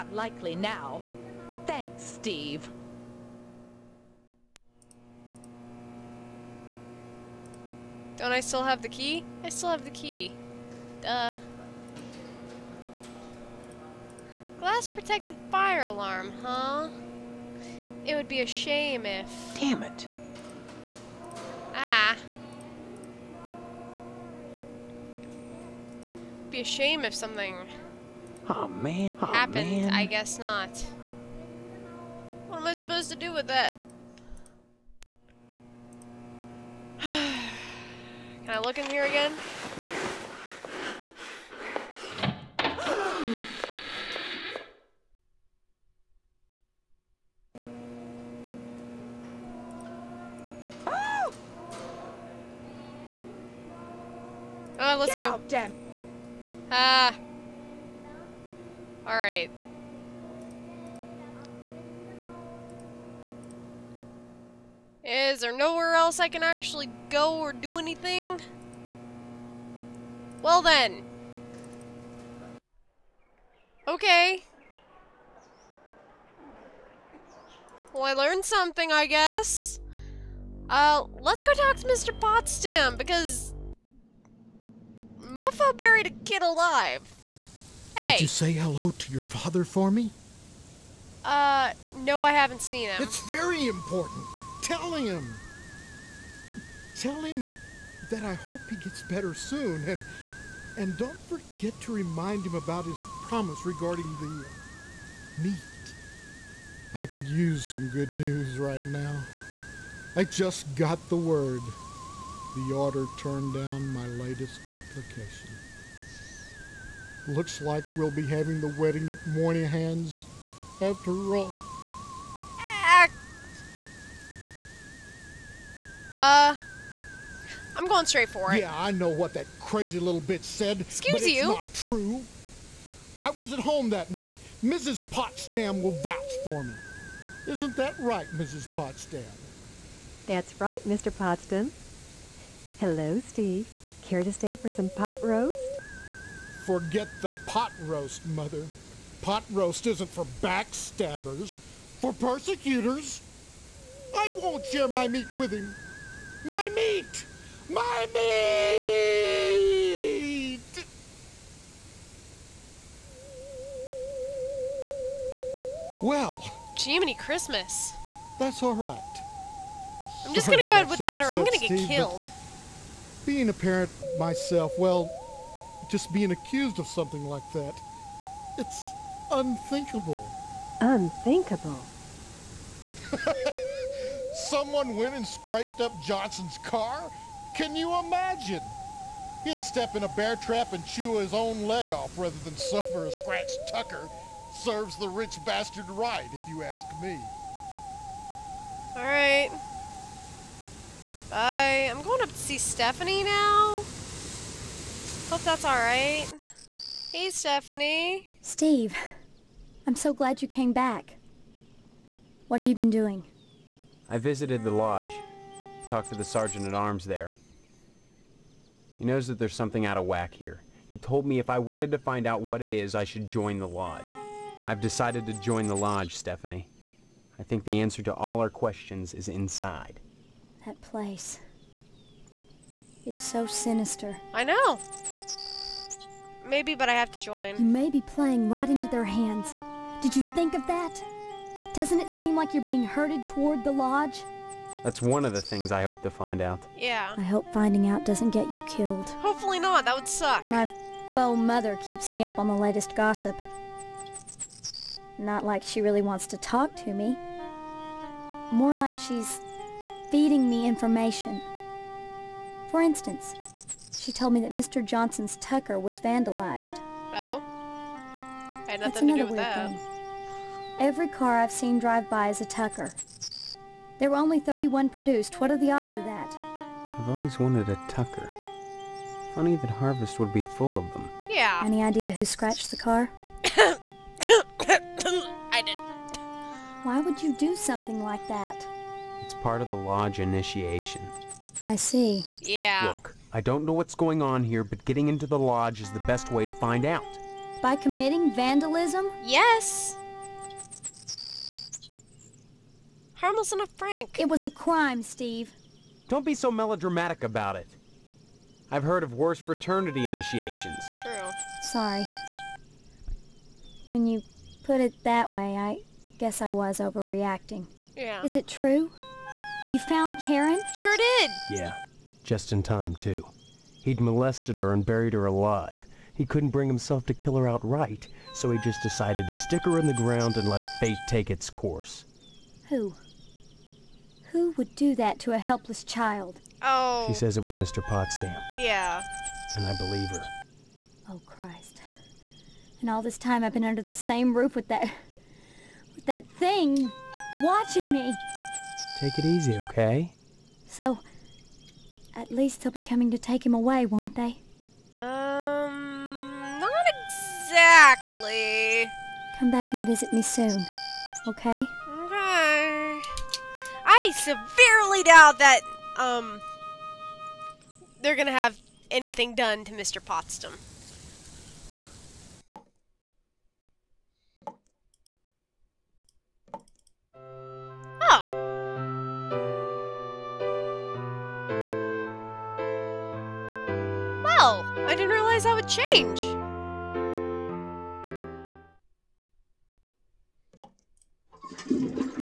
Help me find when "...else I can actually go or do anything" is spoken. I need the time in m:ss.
1:05.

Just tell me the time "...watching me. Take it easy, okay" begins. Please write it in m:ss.
5:47.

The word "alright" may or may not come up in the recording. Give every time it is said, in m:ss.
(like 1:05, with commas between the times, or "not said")
0:59, 3:25.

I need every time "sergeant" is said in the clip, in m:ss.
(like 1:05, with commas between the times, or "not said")
3:36.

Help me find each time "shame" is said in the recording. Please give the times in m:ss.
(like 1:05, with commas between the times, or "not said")
0:18, 0:26.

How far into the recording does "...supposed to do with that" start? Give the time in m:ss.
0:32.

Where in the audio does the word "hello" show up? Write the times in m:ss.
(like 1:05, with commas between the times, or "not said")
1:28, 2:22.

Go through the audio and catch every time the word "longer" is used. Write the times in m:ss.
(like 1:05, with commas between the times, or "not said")
not said.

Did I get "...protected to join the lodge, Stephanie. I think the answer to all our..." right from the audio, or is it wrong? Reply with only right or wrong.
wrong.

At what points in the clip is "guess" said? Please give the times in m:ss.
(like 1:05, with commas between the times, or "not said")
0:30, 1:19, 5:16.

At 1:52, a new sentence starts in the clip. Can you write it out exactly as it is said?
The order turned down my latest application.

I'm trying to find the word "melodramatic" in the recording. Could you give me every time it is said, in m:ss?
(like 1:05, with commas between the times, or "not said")
5:06.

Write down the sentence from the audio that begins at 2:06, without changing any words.
Uh, I'm going straight for it.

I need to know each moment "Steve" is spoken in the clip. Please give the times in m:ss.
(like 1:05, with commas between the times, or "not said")
0:02, 2:23, 2:51, 3:28, 5:05.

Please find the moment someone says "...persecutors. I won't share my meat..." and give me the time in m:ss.
2:32.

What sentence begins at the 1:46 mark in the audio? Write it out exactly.
I could use some good news right now.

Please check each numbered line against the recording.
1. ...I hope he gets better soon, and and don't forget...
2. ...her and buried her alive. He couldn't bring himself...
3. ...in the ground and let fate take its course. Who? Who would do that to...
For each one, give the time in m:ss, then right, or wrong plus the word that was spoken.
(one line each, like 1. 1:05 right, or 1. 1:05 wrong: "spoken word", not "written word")
1. 1:38 right
2. 5:24 right
3. 5:29 right.